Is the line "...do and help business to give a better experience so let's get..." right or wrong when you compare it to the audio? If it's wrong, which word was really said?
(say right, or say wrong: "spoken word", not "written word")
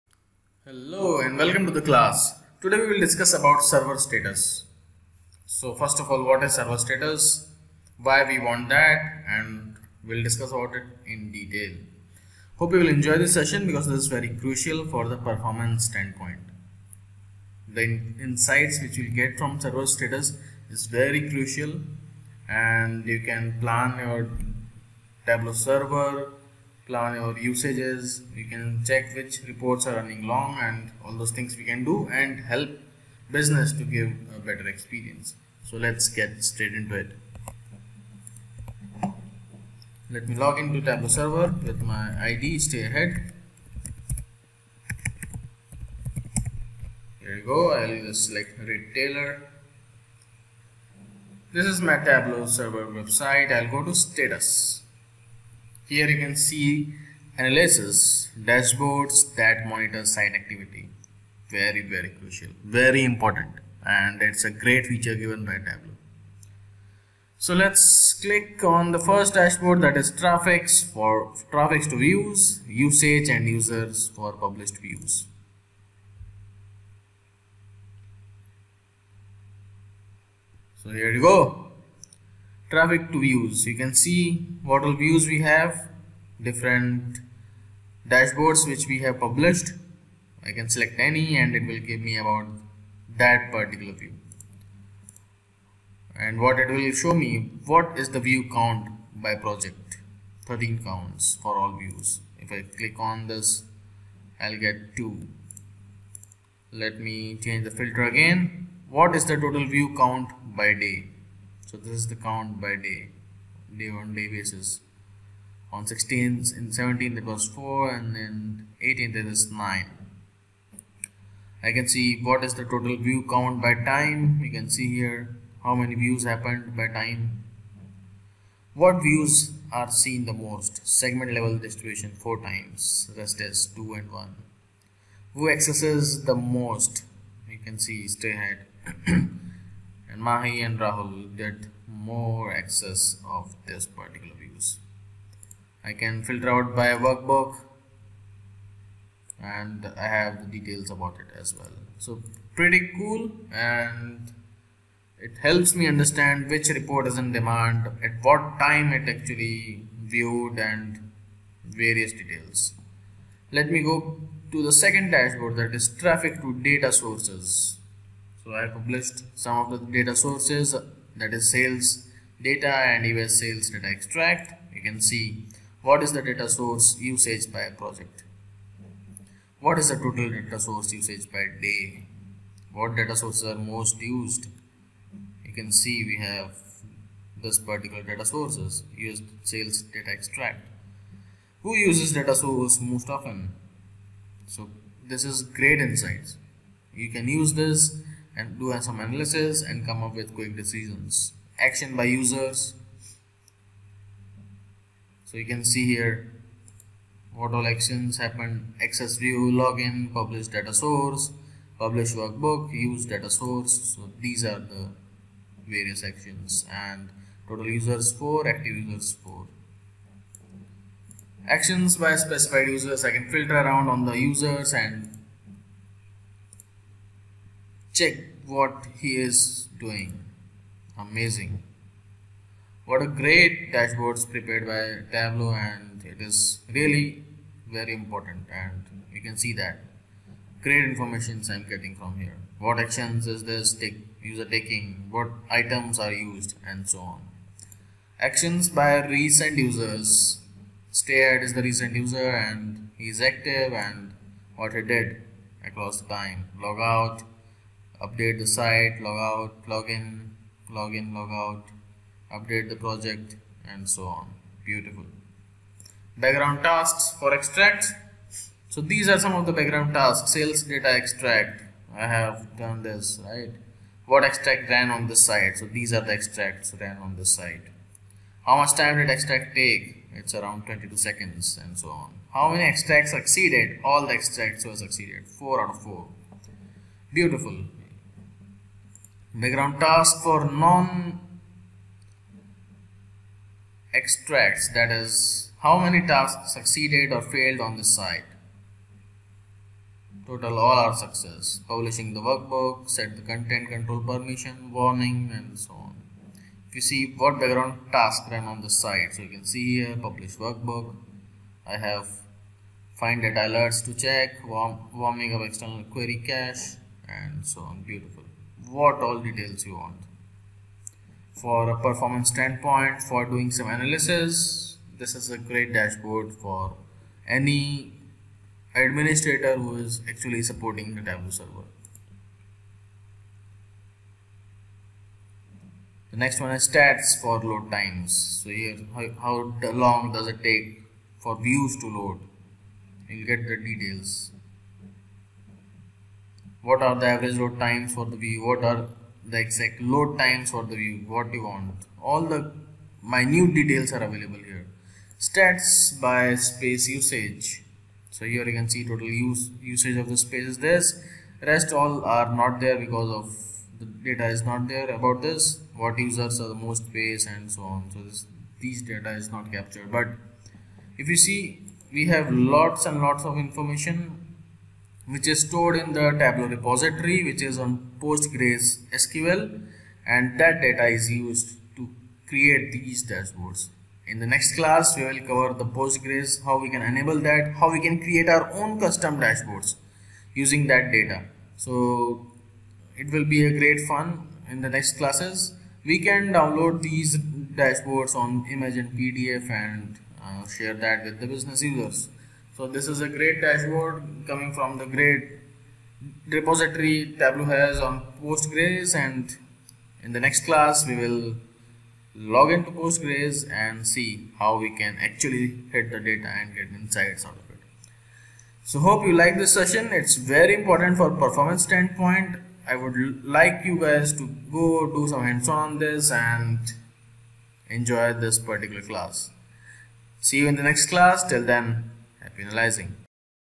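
right.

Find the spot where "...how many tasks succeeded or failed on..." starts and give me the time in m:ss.
4:55.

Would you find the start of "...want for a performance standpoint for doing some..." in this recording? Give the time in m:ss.
5:19.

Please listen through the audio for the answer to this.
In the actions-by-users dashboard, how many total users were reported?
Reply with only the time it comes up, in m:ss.
3:37.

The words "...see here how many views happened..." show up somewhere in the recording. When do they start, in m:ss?
2:04.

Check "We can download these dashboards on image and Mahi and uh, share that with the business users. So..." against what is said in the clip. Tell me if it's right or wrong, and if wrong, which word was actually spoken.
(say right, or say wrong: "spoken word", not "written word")
wrong: "PDF", not "Mahi".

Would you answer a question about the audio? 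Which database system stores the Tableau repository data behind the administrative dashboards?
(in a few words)
Postgres SQL.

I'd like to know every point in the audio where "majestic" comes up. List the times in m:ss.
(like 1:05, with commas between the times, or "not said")
not said.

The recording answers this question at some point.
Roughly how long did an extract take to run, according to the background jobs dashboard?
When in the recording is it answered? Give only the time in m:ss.
4:40.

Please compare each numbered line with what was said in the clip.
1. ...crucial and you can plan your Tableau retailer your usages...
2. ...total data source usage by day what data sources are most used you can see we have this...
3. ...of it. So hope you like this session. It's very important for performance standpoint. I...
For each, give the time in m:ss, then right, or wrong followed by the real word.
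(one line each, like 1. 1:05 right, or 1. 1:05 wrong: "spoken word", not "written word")
1. 0:21 wrong: "server", not "retailer"
2. 2:59 right
3. 6:57 right.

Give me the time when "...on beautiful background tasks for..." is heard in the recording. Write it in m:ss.
4:24.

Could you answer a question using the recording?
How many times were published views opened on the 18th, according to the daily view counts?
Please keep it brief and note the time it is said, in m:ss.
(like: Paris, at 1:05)
9, at 1:59.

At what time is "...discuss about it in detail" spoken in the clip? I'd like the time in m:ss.
0:10.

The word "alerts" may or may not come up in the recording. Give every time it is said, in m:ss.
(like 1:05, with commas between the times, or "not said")
5:13.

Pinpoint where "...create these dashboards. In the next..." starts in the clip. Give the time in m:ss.
6:22.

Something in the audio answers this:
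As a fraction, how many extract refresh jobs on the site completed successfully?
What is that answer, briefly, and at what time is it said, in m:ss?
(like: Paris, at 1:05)
4 out of 4, at 4:45.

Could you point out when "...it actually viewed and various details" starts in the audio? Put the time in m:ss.
2:38.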